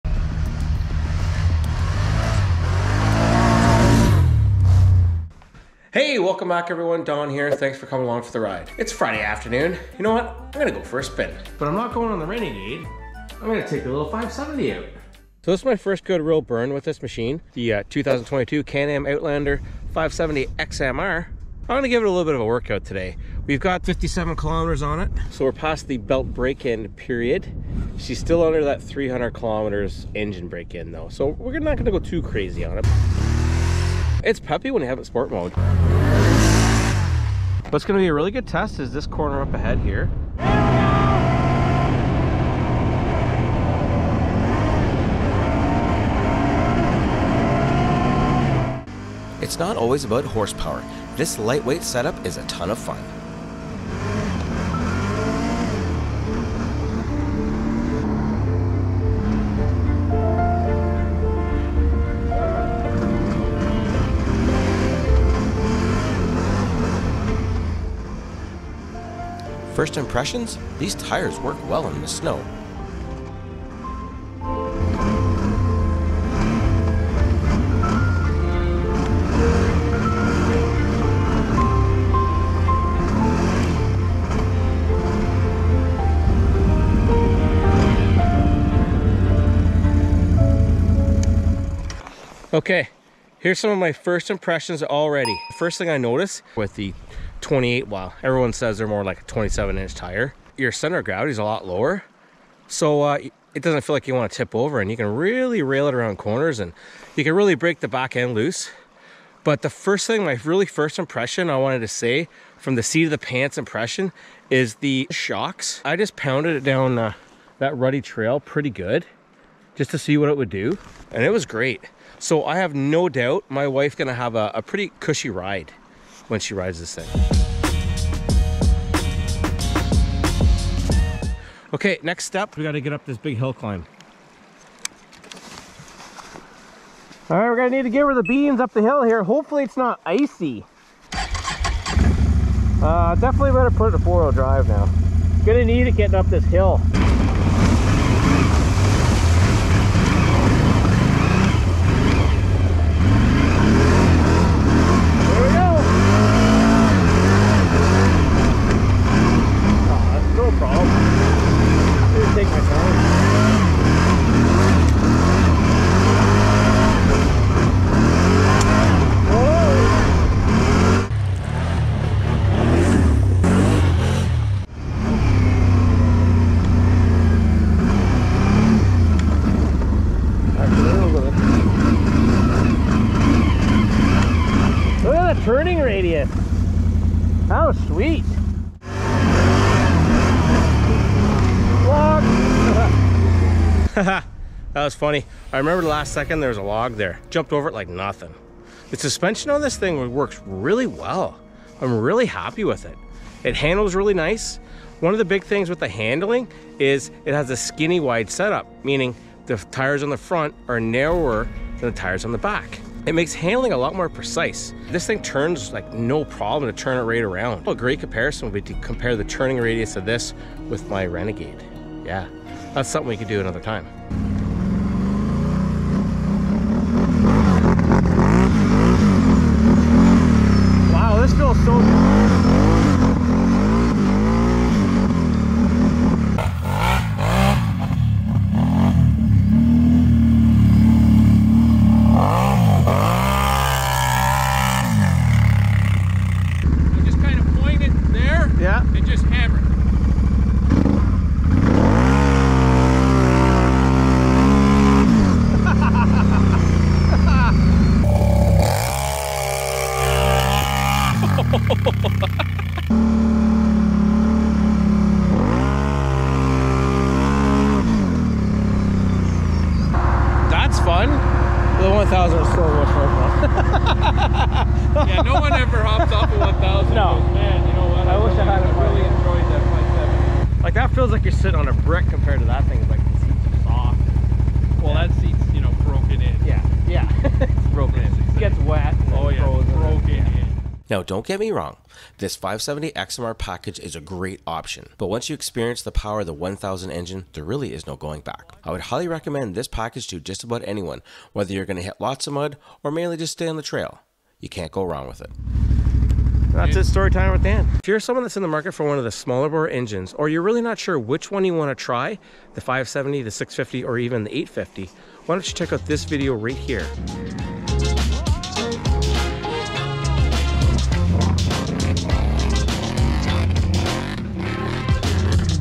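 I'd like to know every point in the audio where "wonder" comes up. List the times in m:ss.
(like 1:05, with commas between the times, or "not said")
not said.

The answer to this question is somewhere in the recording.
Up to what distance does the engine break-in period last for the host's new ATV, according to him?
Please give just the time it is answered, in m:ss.
0:28.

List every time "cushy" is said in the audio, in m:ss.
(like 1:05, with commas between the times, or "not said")
2:04.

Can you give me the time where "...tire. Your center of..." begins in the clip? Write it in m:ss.
1:39.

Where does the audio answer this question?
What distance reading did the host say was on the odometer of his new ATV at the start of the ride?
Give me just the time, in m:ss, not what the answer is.
0:23.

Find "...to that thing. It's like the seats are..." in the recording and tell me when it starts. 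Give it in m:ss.
4:42.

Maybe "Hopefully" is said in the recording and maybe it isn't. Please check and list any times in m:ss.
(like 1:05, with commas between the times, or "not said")
2:19.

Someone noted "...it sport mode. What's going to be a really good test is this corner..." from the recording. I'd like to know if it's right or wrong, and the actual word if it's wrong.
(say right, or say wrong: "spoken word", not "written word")
right.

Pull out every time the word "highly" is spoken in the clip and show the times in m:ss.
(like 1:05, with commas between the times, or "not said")
4:58.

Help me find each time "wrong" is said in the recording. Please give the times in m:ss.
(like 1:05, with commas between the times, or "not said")
4:51, 5:04.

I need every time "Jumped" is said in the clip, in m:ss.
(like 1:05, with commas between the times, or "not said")
3:17.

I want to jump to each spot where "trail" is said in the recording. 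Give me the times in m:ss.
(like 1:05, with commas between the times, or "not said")
1:58, 5:03.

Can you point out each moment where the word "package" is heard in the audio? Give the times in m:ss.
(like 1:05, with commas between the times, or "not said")
4:53, 4:59.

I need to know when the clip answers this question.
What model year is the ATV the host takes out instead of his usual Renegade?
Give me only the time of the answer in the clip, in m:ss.
0:17.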